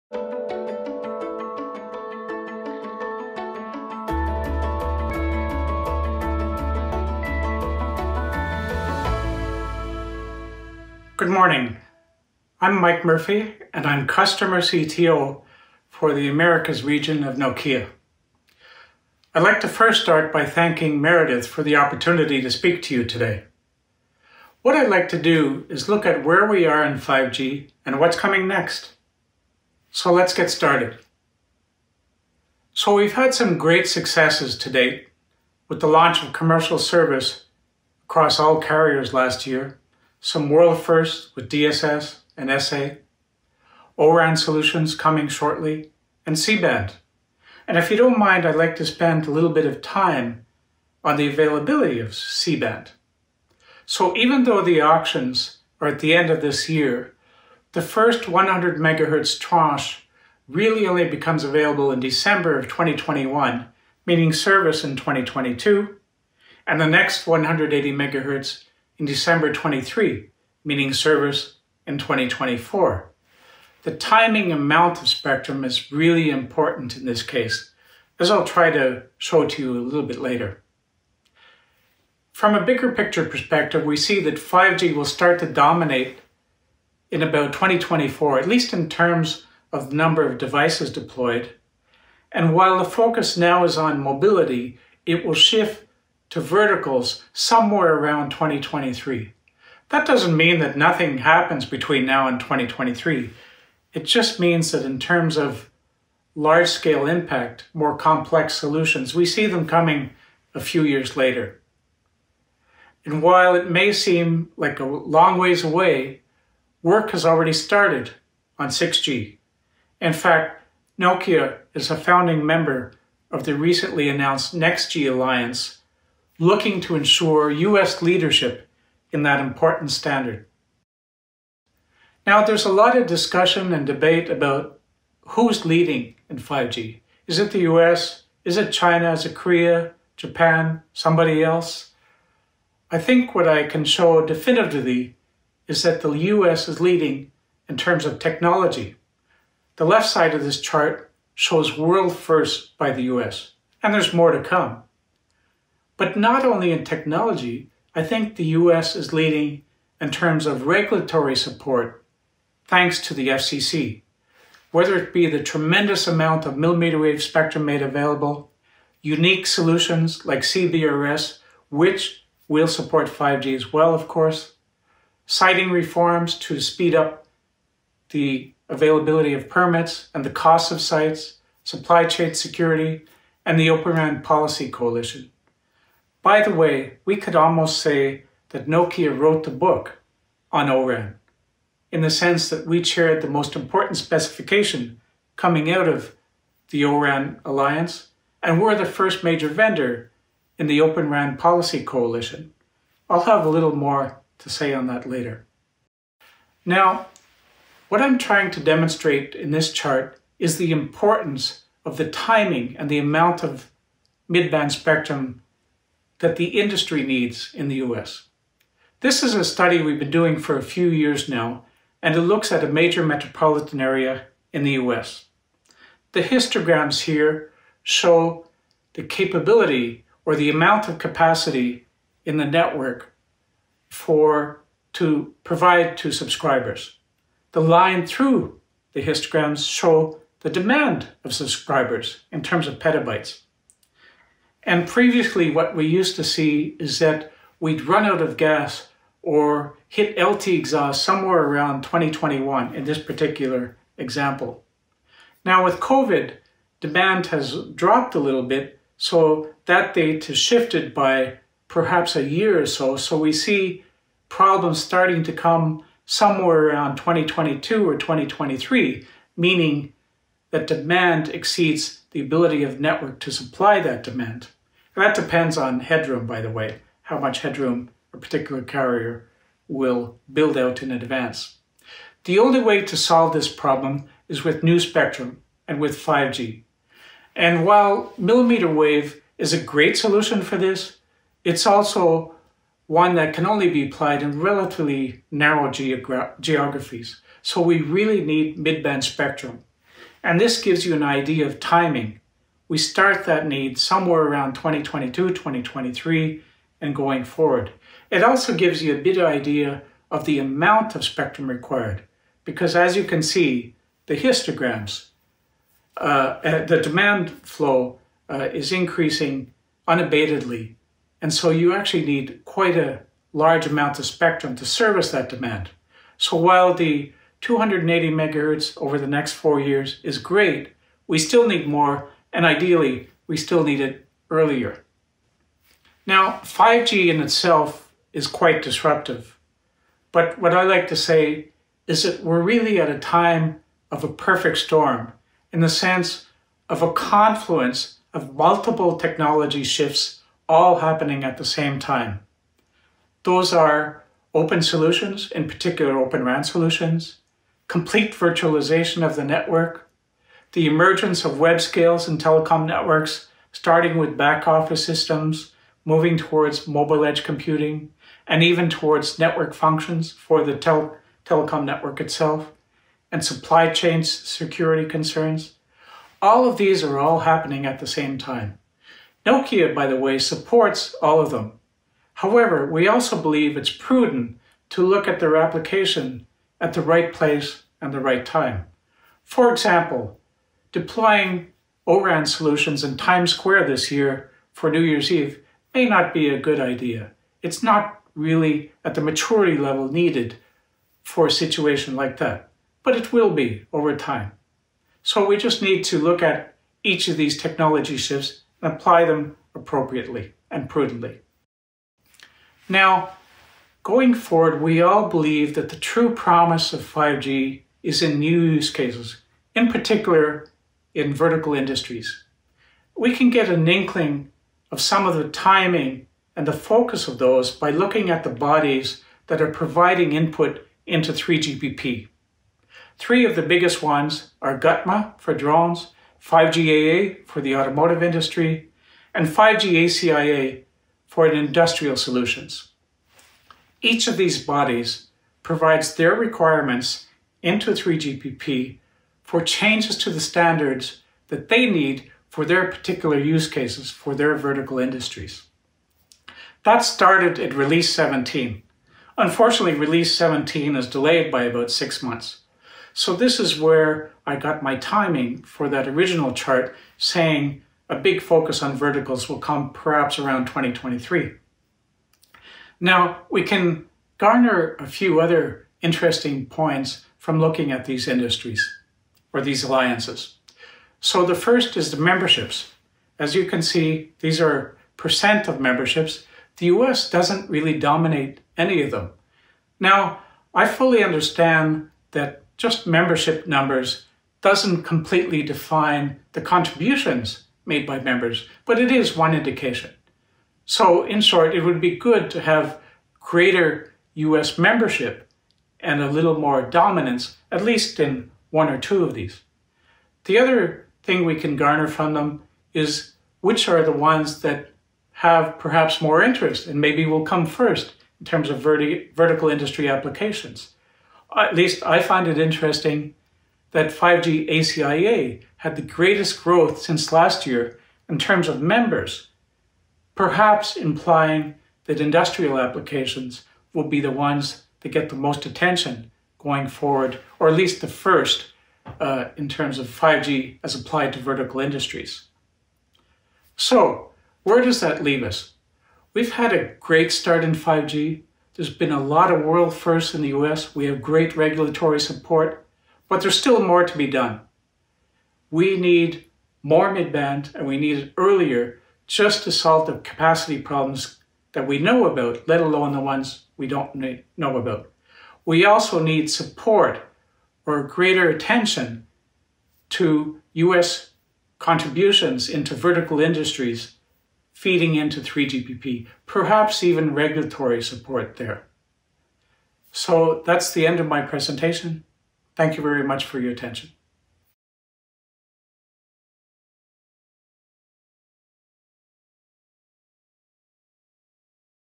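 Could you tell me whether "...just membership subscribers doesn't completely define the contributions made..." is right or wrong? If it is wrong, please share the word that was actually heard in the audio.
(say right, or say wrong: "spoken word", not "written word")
wrong: "numbers", not "subscribers".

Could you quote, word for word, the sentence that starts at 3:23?
I'll have a little more to say on that later.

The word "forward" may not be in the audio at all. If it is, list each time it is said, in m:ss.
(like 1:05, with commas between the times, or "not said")
5:07, 6:54, 8:56.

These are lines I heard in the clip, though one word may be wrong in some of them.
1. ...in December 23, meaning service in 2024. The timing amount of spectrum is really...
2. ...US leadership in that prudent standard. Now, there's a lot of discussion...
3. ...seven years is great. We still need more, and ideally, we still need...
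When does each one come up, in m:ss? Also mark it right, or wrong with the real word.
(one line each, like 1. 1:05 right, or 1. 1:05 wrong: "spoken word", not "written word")
1. 1:09 right
2. 2:07 wrong: "important", not "prudent"
3. 5:29 wrong: "four", not "seven".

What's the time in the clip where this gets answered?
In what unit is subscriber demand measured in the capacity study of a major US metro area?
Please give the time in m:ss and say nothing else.
4:02.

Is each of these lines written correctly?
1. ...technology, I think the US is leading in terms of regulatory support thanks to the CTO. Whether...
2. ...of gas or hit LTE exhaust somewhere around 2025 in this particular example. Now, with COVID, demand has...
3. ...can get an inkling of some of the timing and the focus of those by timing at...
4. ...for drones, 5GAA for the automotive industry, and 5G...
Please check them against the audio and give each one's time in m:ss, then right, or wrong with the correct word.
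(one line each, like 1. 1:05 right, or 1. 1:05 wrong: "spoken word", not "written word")
1. 2:36 wrong: "FCC", not "CTO"
2. 4:08 wrong: "2021", not "2025"
3. 7:03 wrong: "looking", not "timing"
4. 7:15 right.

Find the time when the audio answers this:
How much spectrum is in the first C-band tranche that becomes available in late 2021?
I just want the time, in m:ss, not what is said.
0:58.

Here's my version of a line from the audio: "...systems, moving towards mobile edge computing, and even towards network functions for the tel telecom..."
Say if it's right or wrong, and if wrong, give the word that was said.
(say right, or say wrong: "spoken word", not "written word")
right.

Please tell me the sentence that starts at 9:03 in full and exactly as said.
So, where does that leave us?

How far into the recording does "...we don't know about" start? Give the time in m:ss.
9:23.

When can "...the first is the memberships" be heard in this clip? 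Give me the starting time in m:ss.
8:01.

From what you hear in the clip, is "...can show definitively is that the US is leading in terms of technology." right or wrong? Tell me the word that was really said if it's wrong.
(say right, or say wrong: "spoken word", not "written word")
right.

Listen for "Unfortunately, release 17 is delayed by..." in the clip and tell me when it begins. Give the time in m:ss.
7:39.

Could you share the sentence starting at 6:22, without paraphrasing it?
However, we also believe it's prudent to look at their application at the right place and the right time.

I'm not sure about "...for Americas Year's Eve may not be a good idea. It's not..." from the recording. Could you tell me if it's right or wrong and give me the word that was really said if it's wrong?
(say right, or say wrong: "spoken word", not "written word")
wrong: "New", not "Americas".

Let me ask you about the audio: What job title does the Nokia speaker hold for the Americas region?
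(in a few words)
Customer CTO.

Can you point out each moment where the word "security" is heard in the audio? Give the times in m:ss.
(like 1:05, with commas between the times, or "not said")
3:02, 6:14.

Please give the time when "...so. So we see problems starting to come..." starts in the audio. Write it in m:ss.
4:22.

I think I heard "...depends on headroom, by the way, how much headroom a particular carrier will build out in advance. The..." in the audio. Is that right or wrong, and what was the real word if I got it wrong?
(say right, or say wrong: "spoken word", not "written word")
right.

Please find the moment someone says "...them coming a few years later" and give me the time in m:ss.
1:49.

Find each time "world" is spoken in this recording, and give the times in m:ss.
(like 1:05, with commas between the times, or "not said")
0:40, 2:31, 9:09.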